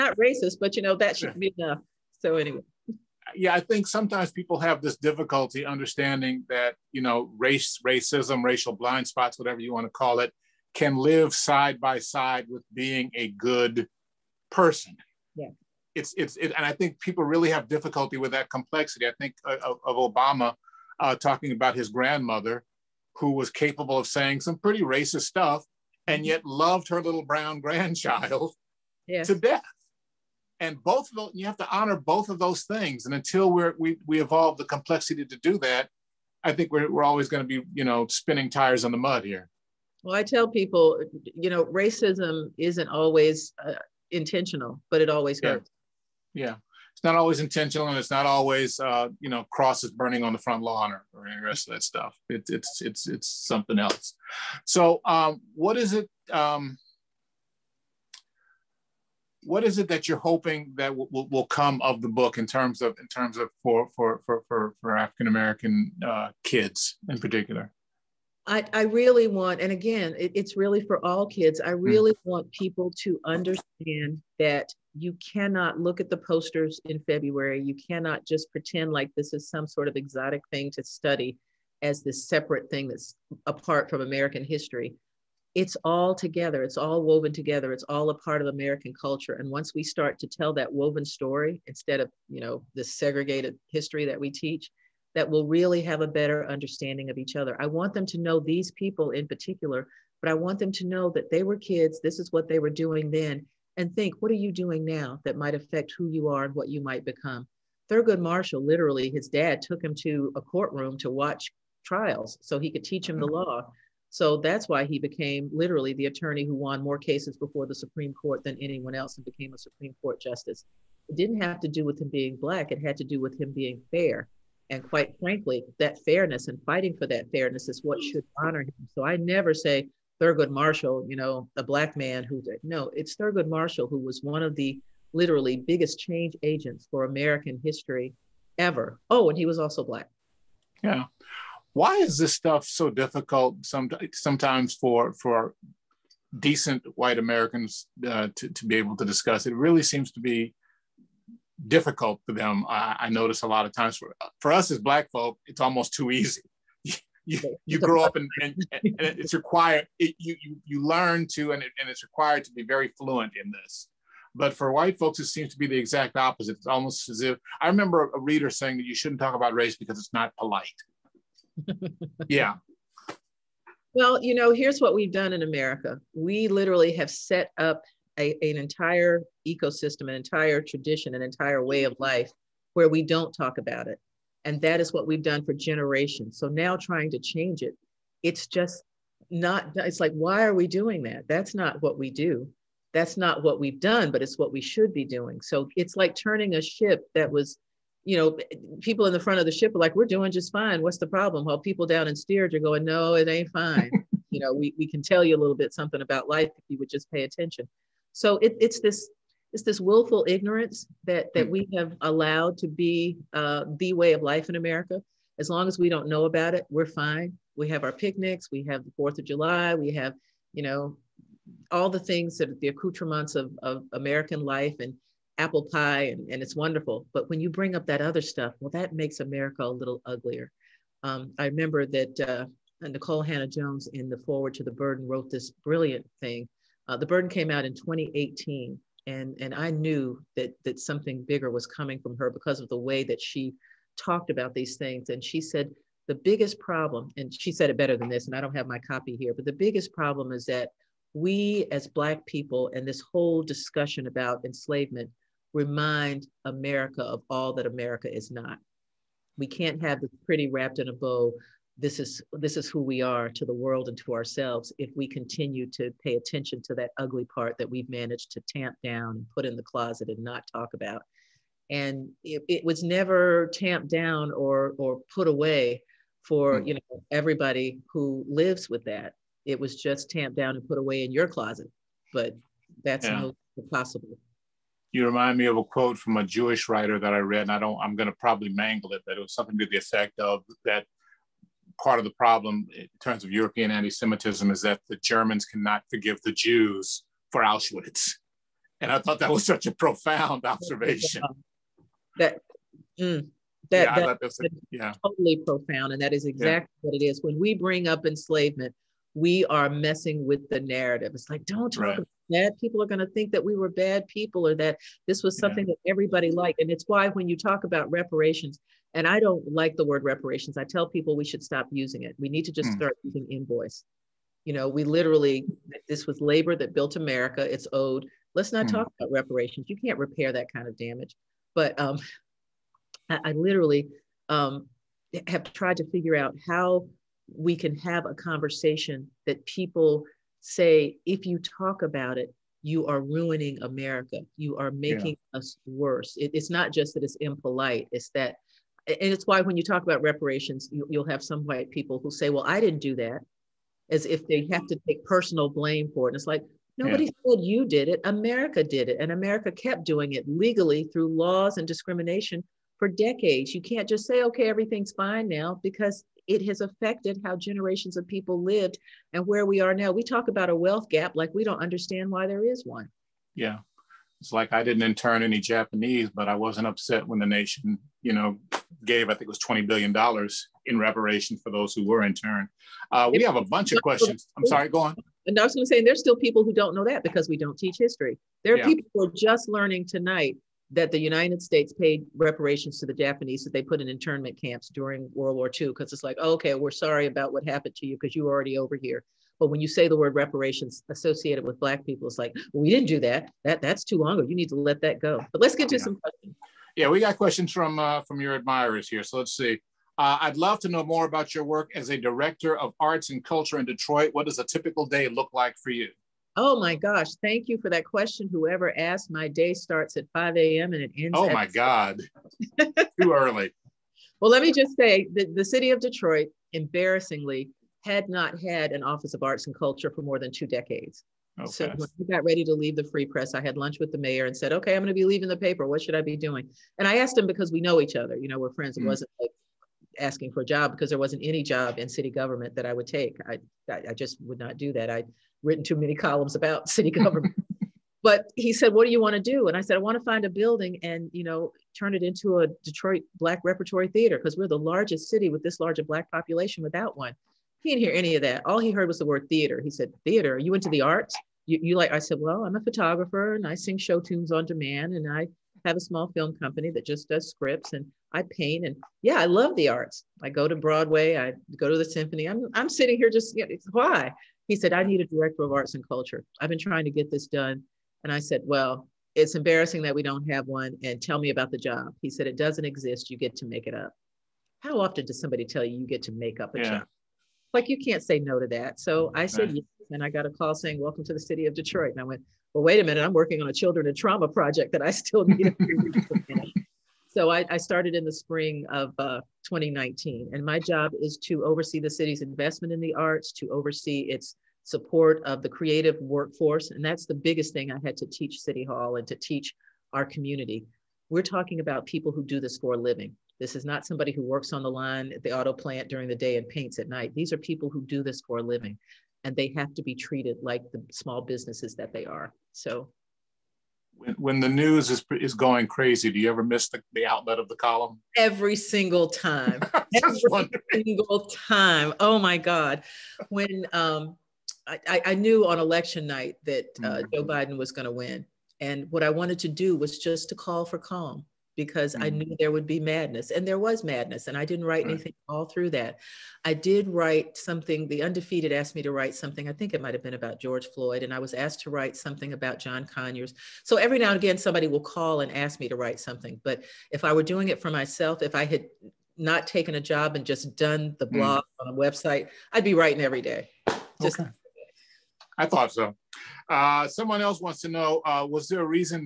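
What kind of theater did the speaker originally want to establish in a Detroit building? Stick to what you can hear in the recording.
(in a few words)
Detroit Black Repertory Theater.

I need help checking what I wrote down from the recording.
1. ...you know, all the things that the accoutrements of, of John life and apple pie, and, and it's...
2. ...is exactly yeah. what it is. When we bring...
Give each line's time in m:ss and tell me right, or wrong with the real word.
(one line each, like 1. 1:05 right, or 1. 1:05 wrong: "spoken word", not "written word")
1. 3:40 wrong: "American", not "John"
2. 5:06 right.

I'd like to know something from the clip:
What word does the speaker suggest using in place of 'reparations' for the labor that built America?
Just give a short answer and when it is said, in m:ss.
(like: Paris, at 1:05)
Invoice, at 5:23.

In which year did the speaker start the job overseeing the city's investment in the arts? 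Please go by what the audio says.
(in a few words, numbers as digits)
2019.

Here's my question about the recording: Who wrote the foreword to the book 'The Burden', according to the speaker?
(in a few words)
Nikole Hannah-Jones.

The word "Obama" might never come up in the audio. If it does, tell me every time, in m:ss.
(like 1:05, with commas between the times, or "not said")
0:19.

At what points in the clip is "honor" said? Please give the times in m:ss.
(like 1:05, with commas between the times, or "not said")
0:31, 2:08.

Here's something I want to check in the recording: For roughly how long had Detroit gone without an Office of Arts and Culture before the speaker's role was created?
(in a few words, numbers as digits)
More than two decades.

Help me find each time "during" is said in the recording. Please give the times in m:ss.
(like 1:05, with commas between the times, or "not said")
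6:34, 8:35.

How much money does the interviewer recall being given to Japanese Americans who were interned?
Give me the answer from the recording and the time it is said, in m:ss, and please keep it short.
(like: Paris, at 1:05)
$20 billion, at 6:19.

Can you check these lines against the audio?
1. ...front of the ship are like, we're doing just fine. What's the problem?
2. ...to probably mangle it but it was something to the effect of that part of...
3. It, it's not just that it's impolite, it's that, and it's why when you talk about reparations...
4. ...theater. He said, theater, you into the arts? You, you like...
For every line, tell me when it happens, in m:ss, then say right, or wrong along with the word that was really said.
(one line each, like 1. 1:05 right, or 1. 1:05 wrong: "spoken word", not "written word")
1. 3:19 right
2. 4:48 right
3. 5:46 right
4. 7:39 right.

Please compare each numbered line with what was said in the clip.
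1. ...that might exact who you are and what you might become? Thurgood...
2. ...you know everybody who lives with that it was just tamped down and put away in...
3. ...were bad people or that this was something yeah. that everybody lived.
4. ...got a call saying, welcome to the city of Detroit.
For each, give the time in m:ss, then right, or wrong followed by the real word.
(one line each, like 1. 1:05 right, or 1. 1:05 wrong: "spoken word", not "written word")
1. 1:45 wrong: "affect", not "exact"
2. 4:36 right
3. 5:13 wrong: "liked", not "lived"
4. 8:10 right.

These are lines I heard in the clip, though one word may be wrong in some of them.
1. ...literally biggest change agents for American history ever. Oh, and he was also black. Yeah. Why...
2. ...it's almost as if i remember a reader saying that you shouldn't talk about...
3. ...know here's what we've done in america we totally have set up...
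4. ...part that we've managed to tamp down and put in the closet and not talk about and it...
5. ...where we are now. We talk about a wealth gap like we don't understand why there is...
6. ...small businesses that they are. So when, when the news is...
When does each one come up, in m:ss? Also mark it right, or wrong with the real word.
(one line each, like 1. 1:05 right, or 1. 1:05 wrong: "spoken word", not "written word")
1. 2:15 right
2. 2:46 right
3. 2:54 wrong: "literally", not "totally"
4. 4:27 right
5. 6:09 right
6. 8:40 right.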